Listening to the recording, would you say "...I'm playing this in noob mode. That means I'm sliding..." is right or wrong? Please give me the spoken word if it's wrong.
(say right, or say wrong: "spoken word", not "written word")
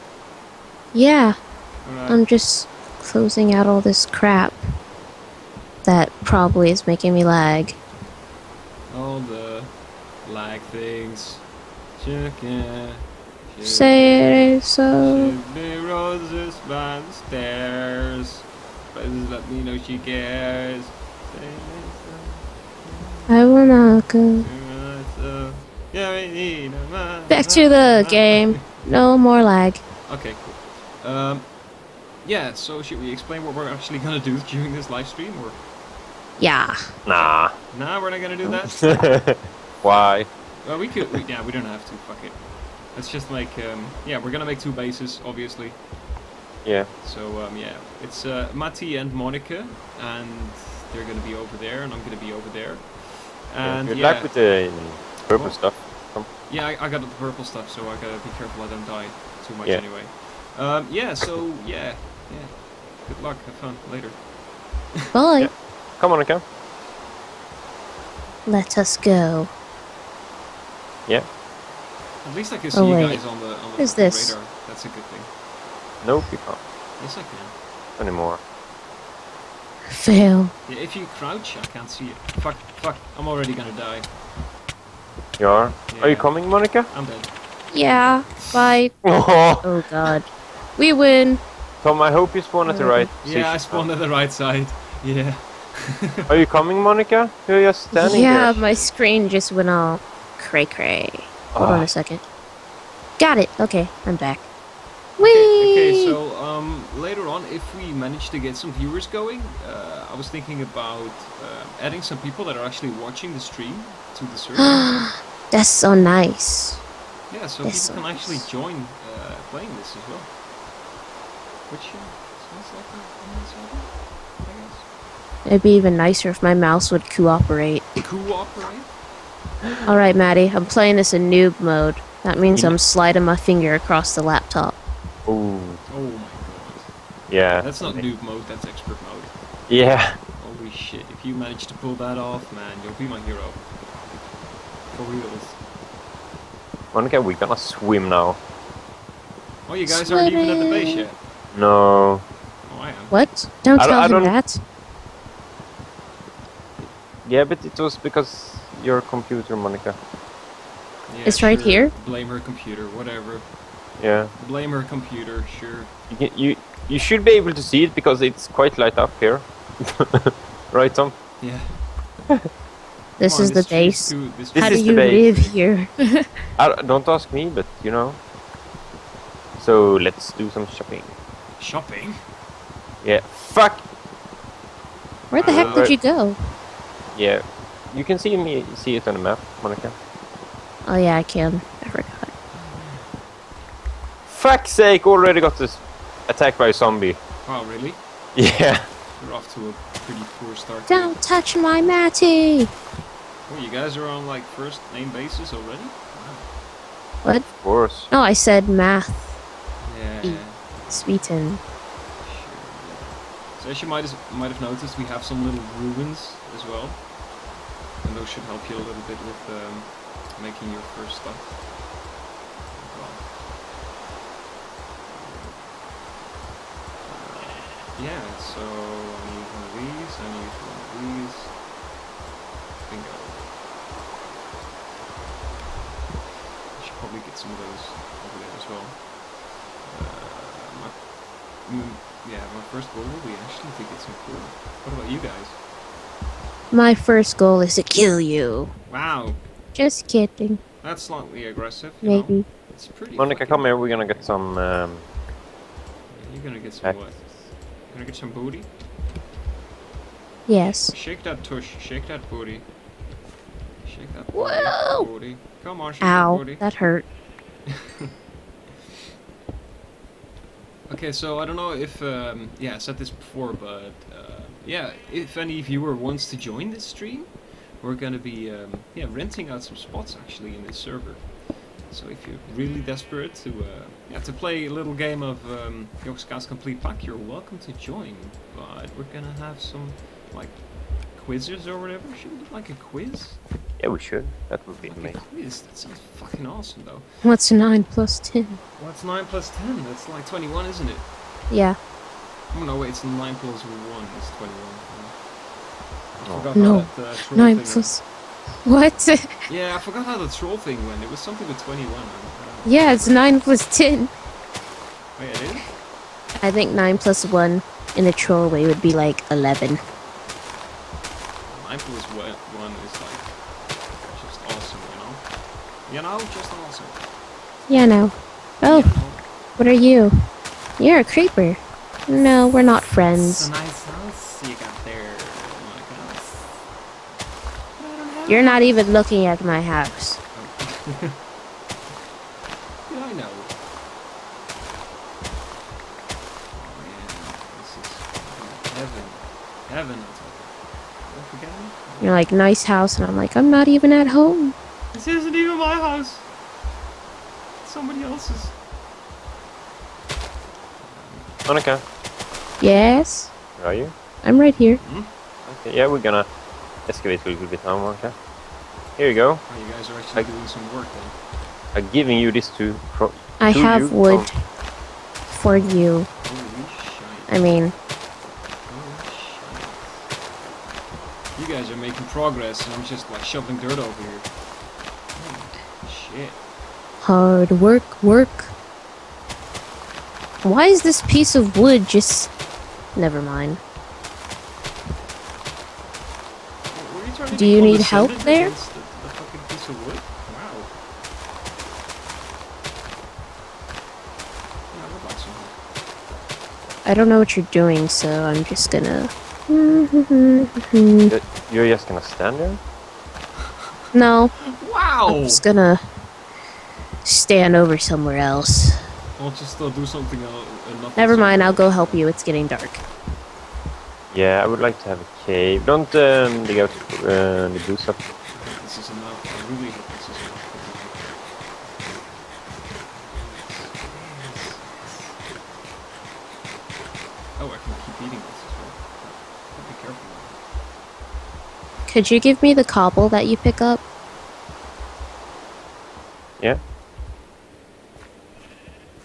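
right.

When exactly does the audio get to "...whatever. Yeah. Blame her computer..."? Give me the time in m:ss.
2:42.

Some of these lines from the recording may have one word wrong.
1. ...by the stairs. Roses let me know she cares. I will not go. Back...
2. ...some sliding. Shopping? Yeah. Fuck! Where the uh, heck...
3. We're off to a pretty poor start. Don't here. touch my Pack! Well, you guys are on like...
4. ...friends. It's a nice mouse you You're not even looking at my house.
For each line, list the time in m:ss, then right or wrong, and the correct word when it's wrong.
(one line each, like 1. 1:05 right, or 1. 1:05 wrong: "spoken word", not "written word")
1. 0:16 right
2. 3:00 wrong: "shopping", not "sliding"
3. 3:19 wrong: "Matty", not "Pack"
4. 5:32 wrong: "house", not "mouse".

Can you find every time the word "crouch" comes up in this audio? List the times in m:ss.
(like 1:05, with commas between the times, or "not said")
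1:21.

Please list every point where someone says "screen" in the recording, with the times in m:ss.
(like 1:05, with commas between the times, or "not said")
1:38.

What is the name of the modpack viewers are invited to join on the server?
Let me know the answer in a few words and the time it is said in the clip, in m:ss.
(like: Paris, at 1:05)
Complete Pack, at 4:46.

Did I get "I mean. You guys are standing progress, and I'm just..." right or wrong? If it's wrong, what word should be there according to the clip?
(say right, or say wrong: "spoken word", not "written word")
wrong: "making", not "standing".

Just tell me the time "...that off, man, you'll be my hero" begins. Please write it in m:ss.
2:21.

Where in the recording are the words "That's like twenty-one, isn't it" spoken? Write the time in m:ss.
4:59.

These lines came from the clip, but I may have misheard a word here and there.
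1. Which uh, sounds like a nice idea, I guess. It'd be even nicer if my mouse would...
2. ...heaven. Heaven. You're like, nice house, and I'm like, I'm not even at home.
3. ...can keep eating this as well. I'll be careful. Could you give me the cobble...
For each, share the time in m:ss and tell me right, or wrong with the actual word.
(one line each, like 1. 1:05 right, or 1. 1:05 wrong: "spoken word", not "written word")
1. 2:01 right
2. 5:48 right
3. 7:17 right.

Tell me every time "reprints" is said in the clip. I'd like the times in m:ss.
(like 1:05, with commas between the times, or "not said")
not said.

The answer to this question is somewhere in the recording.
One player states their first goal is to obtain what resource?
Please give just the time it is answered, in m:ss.
4:04.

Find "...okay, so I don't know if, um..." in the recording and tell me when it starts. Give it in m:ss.
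4:30.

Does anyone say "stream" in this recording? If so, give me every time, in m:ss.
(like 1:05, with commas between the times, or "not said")
0:35, 1:53, 4:36.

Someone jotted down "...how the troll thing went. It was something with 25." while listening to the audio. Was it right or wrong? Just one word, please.
wrong.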